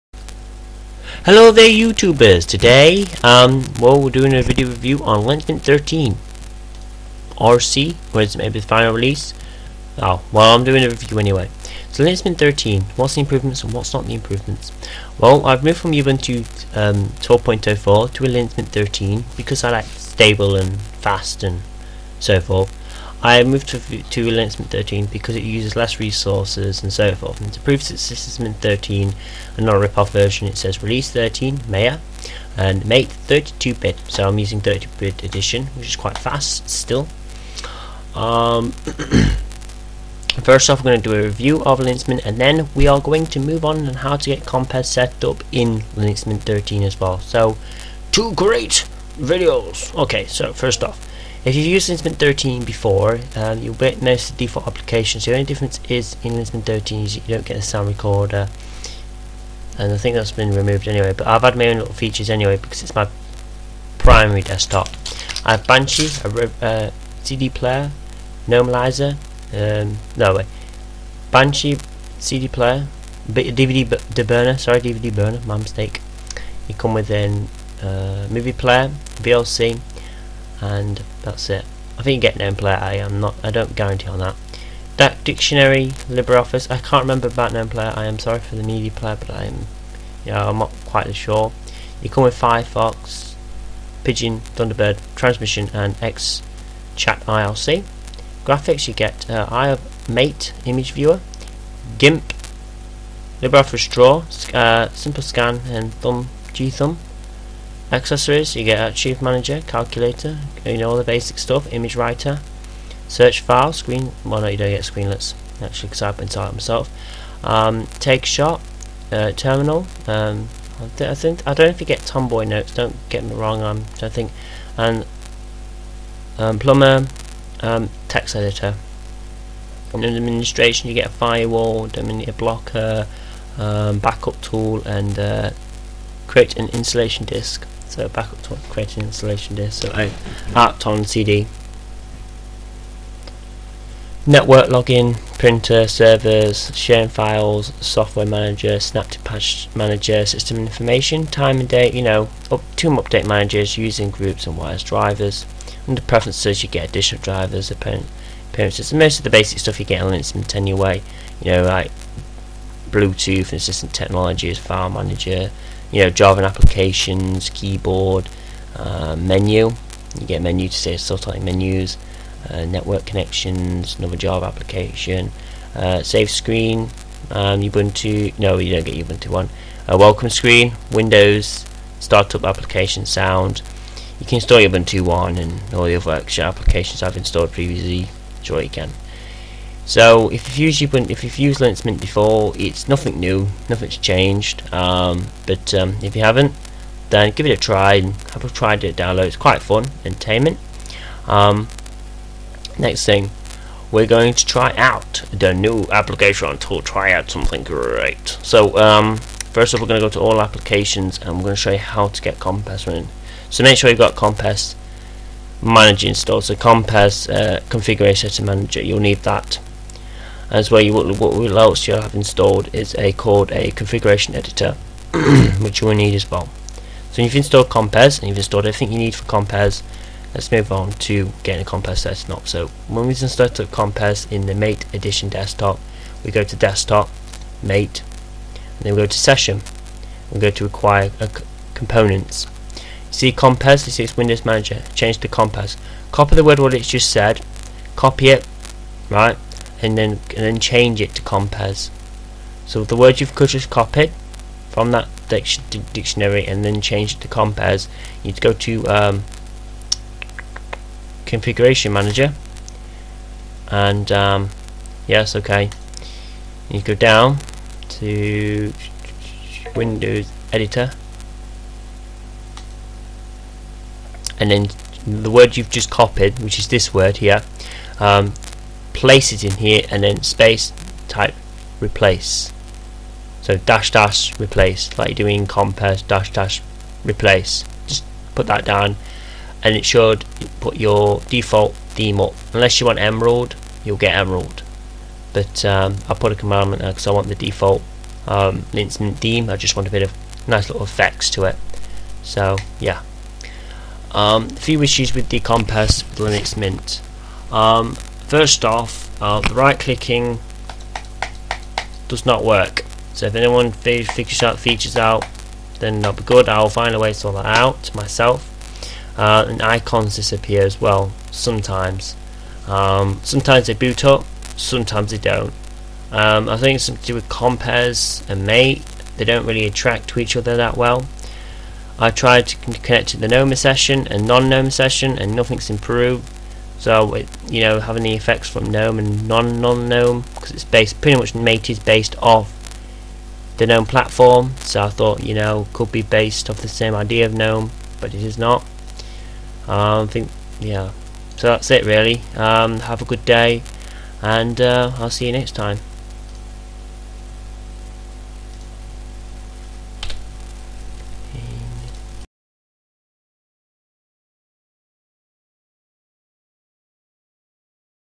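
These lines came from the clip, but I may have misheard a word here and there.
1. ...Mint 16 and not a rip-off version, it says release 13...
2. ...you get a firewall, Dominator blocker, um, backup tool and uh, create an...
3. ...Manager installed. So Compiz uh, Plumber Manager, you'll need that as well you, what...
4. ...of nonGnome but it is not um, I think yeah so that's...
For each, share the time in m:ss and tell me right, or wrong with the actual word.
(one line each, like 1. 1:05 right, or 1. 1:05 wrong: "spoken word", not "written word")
1. 0:28 wrong: "13", not "16"
2. 2:10 right
3. 3:35 wrong: "Configuration", not "Plumber"
4. 5:47 wrong: "gnome", not "nonGnome".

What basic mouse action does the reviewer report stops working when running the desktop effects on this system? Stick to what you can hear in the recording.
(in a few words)
Right clicking.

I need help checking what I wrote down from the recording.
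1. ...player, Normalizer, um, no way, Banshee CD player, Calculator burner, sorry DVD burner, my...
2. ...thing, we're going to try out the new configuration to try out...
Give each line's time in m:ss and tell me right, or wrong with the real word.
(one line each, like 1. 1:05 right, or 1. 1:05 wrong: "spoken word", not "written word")
1. 1:07 wrong: "DVD", not "Calculator"
2. 3:23 wrong: "application", not "configuration".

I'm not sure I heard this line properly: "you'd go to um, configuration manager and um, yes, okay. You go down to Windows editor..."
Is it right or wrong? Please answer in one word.
right.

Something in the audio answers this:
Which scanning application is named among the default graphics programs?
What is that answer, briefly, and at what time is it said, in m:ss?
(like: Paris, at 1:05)
Simple Scan, at 1:44.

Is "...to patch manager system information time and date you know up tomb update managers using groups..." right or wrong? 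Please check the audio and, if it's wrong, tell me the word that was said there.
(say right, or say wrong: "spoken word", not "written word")
right.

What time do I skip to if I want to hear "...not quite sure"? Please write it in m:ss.
1:30.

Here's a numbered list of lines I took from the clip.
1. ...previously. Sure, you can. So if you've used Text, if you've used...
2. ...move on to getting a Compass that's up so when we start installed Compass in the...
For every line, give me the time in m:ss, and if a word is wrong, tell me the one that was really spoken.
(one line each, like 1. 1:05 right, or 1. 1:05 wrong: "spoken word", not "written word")
1. 3:07 wrong: "Ubuntu", not "Text"
2. 3:50 right.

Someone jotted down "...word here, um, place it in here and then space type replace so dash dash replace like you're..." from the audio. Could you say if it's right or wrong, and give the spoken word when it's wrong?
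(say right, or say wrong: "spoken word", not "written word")
right.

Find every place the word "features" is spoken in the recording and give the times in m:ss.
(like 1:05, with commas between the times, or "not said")
1:01, 5:14.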